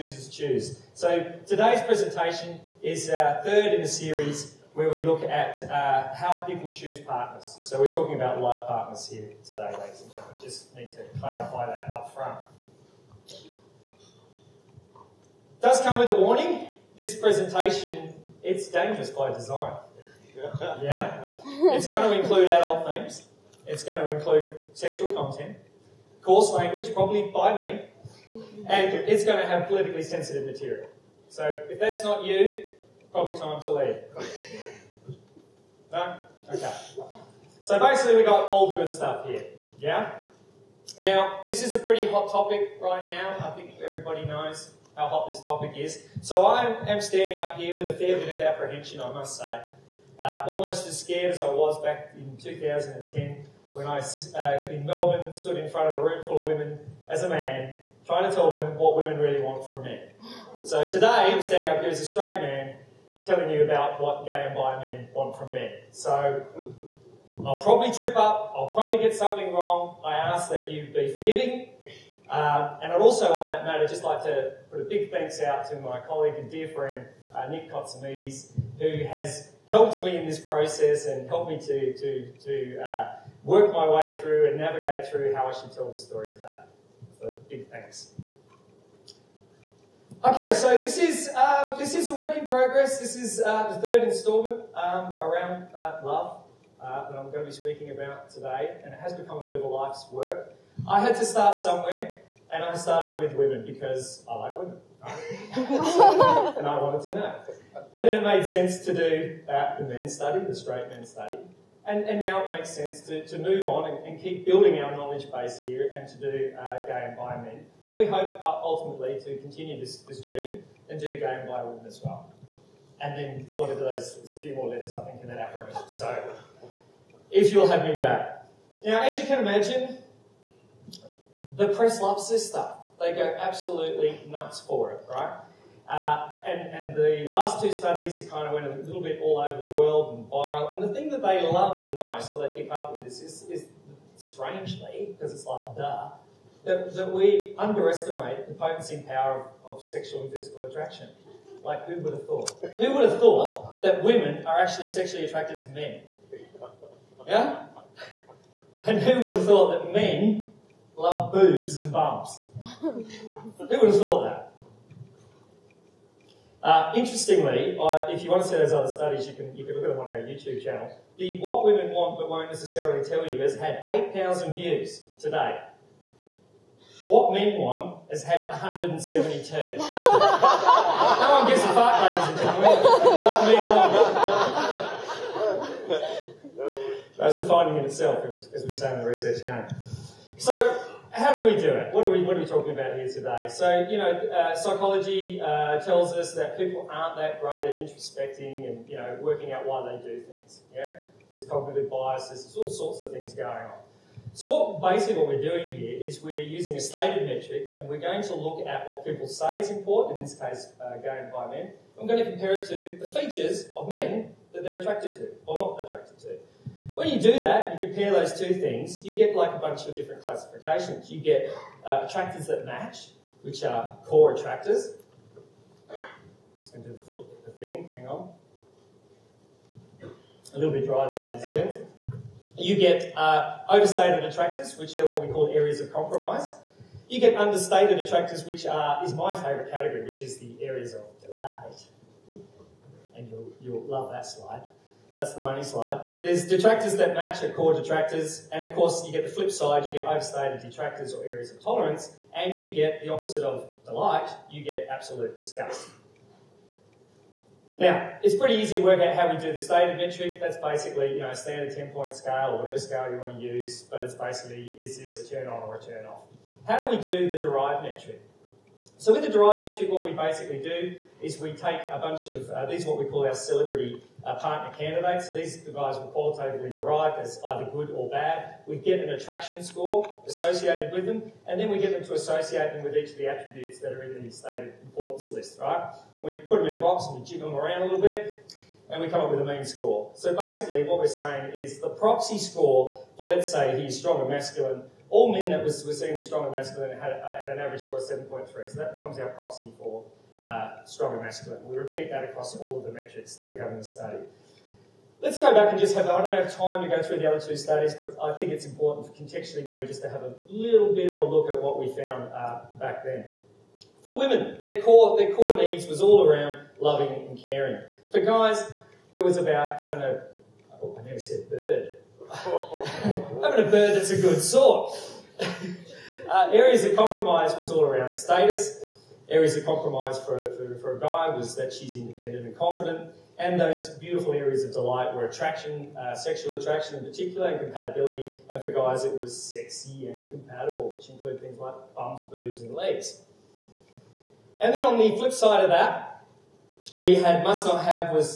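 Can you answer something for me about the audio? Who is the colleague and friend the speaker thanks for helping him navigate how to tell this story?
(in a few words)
Nick Kotsamides.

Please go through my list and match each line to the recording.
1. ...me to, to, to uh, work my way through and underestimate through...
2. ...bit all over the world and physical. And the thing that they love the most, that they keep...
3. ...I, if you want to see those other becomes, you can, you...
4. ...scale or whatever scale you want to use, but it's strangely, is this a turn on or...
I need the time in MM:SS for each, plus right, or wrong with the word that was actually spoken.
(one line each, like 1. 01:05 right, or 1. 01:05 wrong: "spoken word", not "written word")
1. 01:21 wrong: "navigate", not "underestimate"
2. 02:19 wrong: "viral", not "physical"
3. 02:47 wrong: "studies", not "becomes"
4. 04:22 wrong: "basically", not "strangely".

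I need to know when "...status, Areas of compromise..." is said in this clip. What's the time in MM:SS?
05:28.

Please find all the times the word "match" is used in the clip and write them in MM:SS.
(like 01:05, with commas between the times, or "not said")
03:42, 04:07.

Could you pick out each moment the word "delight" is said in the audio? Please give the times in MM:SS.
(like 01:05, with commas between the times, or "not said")
04:01, 04:13, 05:34.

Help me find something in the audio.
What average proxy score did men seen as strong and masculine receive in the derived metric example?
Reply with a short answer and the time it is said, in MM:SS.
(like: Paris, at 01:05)
7.3, at 04:58.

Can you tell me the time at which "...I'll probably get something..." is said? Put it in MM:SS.
01:08.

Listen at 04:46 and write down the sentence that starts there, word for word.
We put them in a box and we jig them around a little bit, and we come up with a mean score.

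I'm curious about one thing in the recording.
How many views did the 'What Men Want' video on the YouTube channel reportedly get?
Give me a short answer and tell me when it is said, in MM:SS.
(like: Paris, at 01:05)
172, at 02:58.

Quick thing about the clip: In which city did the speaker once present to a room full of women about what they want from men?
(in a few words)
Melbourne.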